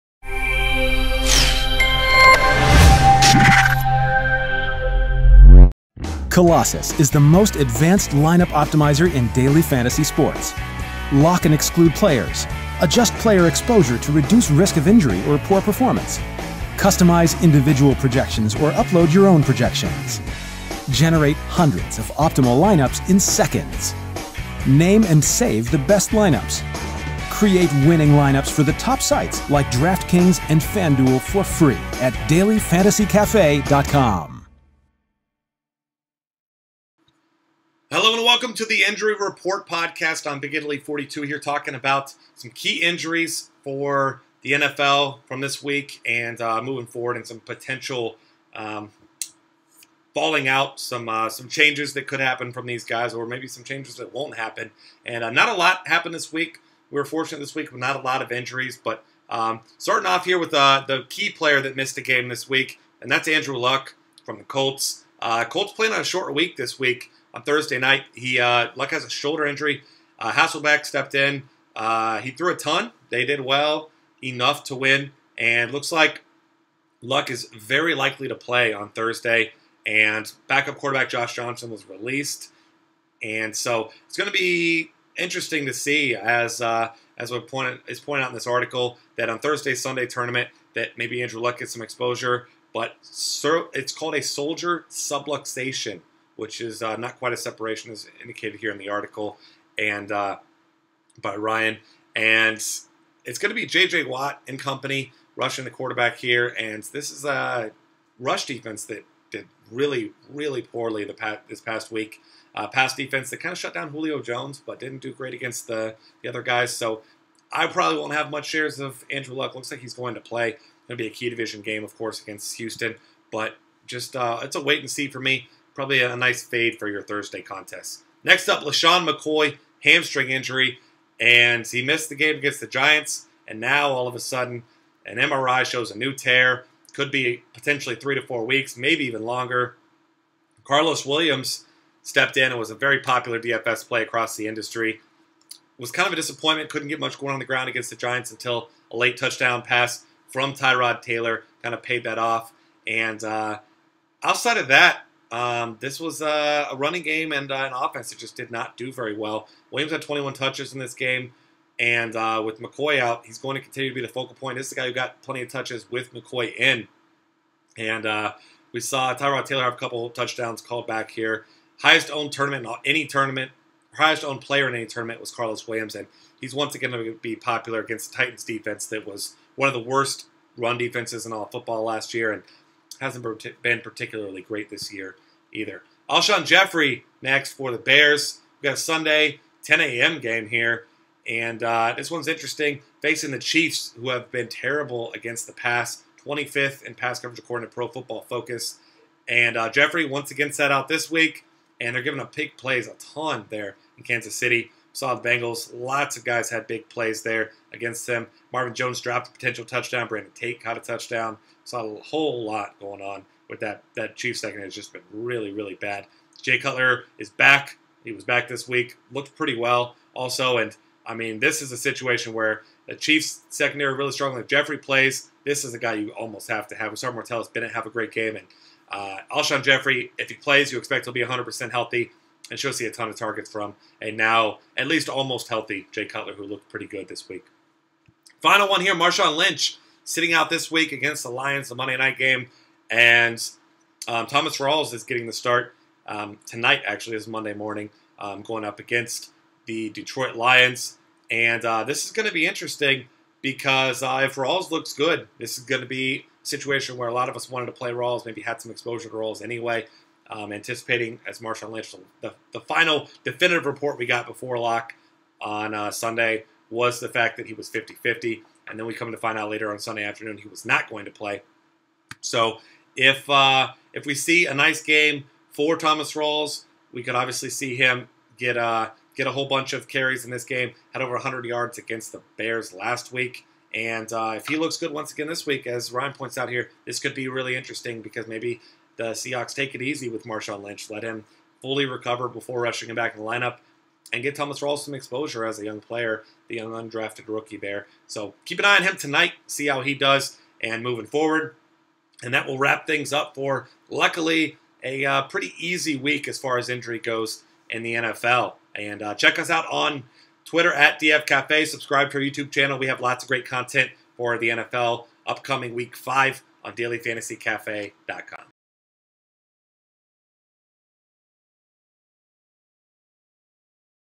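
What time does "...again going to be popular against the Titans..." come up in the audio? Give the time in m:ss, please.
2:56.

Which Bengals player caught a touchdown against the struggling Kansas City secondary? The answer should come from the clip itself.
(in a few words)
Brandon Tate.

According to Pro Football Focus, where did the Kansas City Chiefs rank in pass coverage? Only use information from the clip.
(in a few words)
25th.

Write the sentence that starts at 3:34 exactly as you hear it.
Has just been really, really bad.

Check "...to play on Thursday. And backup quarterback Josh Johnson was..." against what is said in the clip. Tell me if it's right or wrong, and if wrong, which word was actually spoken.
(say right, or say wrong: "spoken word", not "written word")
right.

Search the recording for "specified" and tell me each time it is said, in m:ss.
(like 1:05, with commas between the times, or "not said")
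not said.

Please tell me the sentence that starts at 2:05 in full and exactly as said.
Probably a nice fade for your Thursday contest.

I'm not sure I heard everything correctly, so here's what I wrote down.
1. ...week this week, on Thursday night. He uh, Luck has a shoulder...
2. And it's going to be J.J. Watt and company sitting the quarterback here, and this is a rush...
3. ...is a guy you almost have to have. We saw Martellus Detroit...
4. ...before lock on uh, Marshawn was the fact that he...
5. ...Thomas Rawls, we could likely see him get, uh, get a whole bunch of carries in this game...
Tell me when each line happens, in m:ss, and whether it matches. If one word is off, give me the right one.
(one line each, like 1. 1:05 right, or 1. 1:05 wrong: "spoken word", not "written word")
1. 1:06 right
2. 1:42 wrong: "rushing", not "sitting"
3. 3:45 wrong: "Bennett", not "Detroit"
4. 4:24 wrong: "Sunday", not "Marshawn"
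5. 4:35 wrong: "obviously", not "likely".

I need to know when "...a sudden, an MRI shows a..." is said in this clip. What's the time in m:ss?
2:14.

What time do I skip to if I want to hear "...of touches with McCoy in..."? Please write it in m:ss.
2:45.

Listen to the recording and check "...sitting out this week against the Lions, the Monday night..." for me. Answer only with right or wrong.
right.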